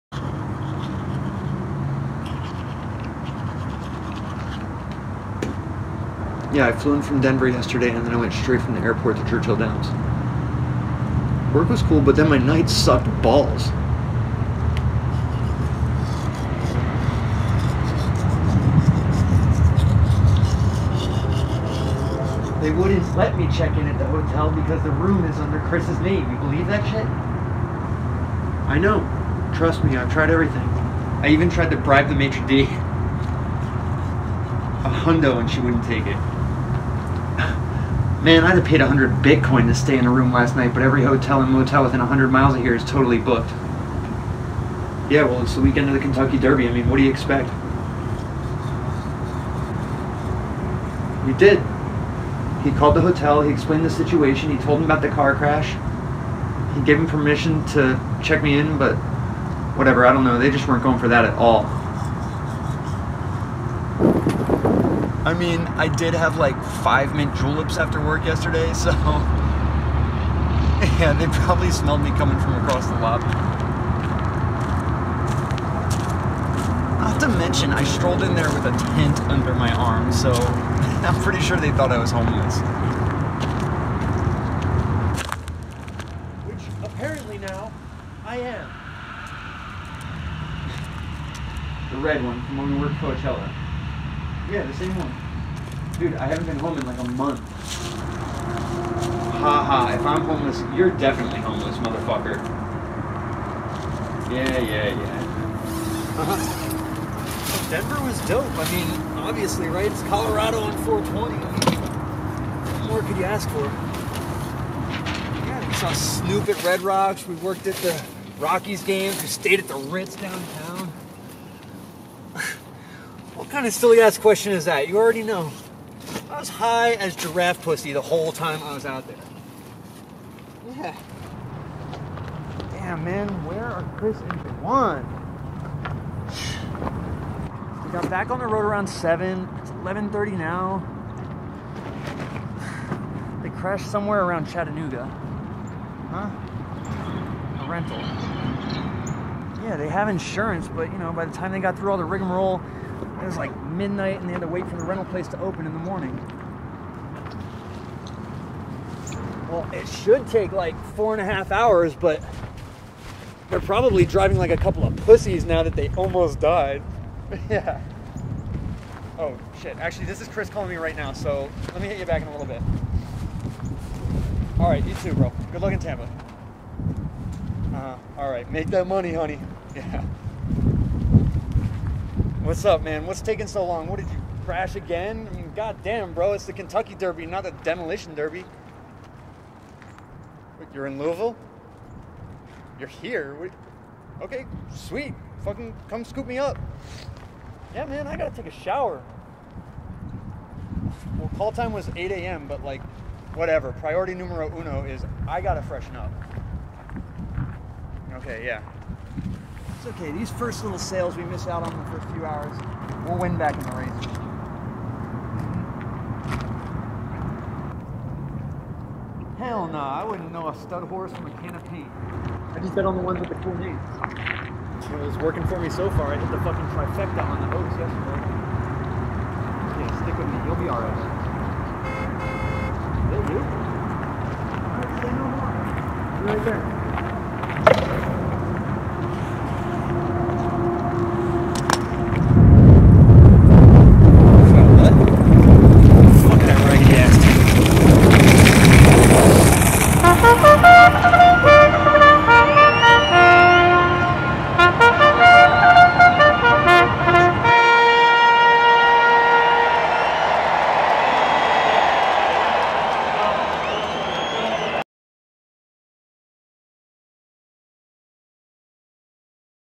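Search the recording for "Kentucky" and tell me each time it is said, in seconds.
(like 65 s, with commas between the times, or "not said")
45 s, 186 s.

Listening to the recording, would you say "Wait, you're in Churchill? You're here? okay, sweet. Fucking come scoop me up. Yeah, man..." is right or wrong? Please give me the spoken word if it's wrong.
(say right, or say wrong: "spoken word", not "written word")
wrong: "Louisville", not "Churchill".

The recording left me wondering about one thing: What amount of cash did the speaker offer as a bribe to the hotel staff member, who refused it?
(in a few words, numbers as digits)
$100.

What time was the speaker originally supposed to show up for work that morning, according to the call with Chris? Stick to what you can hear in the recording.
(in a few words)
8 a.m.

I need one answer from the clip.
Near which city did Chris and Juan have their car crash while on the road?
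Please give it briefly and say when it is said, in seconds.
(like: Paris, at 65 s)
Chattanooga, at 144 s.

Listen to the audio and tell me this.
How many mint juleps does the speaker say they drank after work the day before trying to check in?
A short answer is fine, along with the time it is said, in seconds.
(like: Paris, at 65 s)
5, at 66 s.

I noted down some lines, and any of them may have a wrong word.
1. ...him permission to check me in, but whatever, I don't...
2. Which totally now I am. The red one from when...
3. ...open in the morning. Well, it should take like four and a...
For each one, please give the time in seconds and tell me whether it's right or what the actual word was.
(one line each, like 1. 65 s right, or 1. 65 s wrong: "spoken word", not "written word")
1. 56 s right
2. 86 s wrong: "apparently", not "totally"
3. 155 s right.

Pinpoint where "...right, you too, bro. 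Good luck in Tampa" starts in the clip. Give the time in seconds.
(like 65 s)
174 s.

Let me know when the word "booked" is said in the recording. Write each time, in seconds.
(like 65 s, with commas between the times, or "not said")
43 s.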